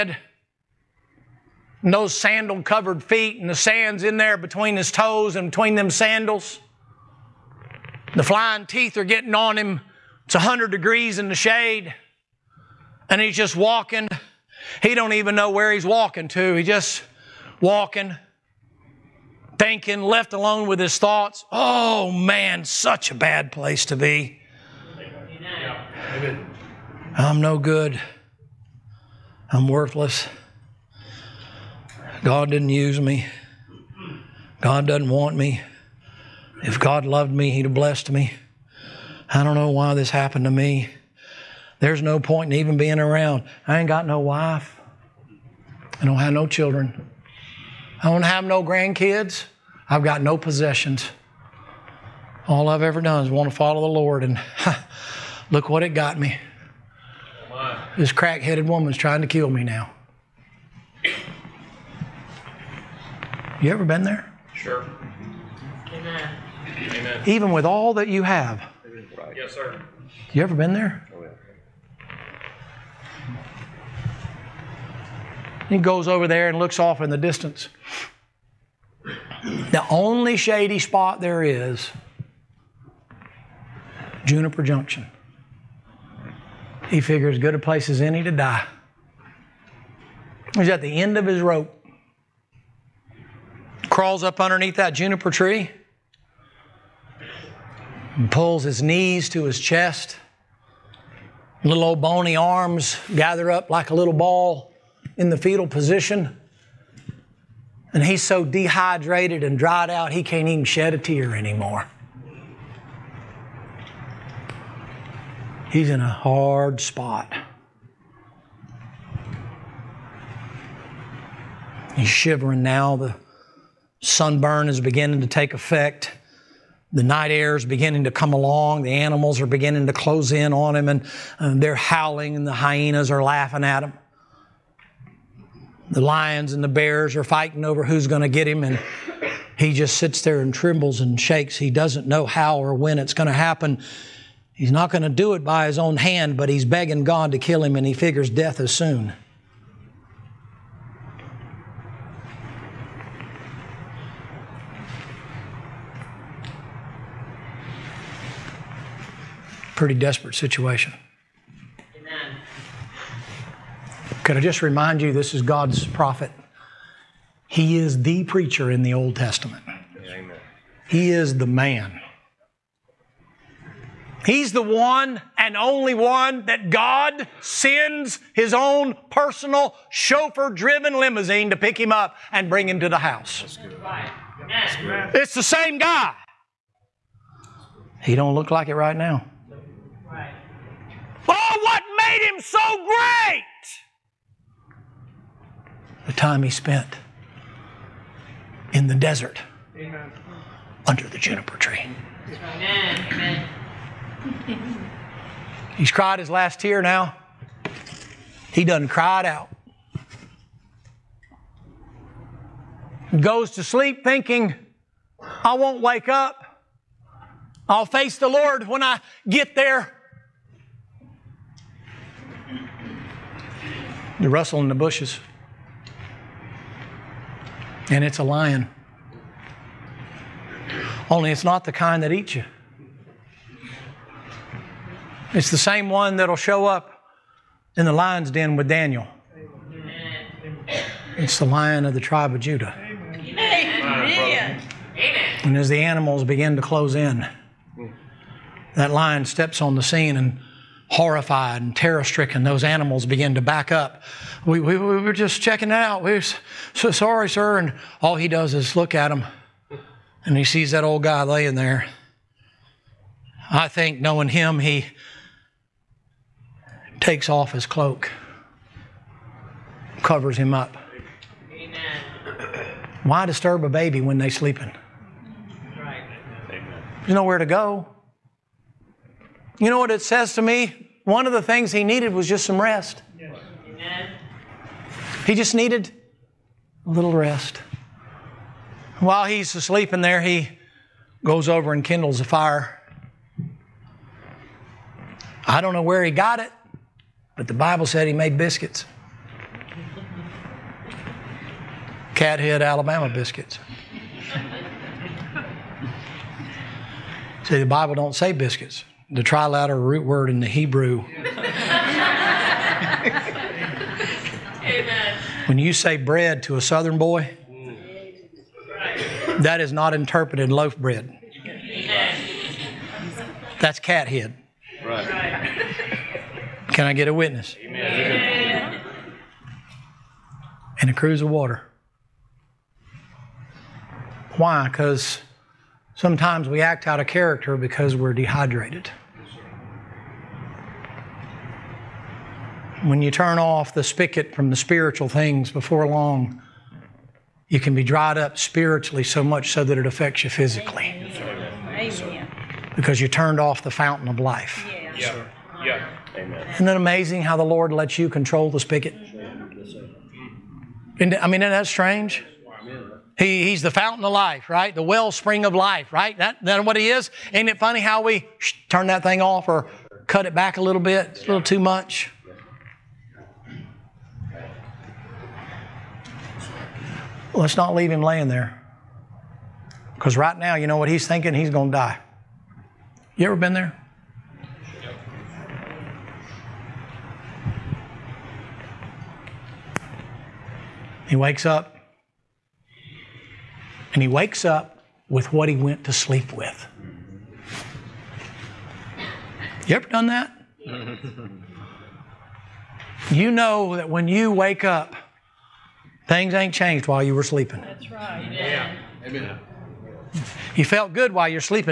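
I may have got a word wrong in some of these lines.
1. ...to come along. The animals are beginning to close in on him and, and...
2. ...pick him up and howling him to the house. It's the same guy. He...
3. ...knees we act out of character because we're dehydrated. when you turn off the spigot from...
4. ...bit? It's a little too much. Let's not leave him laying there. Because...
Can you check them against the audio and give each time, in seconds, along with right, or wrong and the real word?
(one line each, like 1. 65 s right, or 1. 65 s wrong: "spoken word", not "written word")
1. 128 s right
2. 181 s wrong: "bring", not "howling"
3. 335 s wrong: "sometimes", not "knees"
4. 370 s right.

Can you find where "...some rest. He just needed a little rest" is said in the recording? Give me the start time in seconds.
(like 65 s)
282 s.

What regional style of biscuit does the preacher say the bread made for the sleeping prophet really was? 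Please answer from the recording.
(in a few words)
Cathead Alabama biscuits.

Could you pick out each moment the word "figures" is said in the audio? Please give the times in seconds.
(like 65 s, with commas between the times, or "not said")
86 s, 147 s.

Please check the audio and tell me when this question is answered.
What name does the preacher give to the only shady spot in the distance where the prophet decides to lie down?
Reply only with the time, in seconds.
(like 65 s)
84 s.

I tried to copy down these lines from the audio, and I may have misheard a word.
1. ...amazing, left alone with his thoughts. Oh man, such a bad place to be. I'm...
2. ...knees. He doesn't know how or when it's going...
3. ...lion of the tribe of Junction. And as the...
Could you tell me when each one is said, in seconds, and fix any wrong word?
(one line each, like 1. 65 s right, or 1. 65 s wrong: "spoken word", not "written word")
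1. 19 s wrong: "thinking", not "amazing"
2. 141 s wrong: "shakes", not "knees"
3. 241 s wrong: "Judah", not "Junction".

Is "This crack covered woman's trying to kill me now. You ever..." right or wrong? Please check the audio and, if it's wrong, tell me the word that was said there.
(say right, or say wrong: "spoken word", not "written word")
wrong: "headed", not "covered".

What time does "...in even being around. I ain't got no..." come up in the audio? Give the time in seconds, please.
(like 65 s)
42 s.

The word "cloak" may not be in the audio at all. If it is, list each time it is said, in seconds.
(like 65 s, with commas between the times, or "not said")
267 s.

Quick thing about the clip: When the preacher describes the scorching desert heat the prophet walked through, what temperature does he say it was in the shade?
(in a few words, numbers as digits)
100 degrees.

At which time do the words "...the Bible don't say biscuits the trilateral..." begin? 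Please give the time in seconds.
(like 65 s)
307 s.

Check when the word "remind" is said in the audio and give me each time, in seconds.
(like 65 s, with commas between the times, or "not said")
164 s.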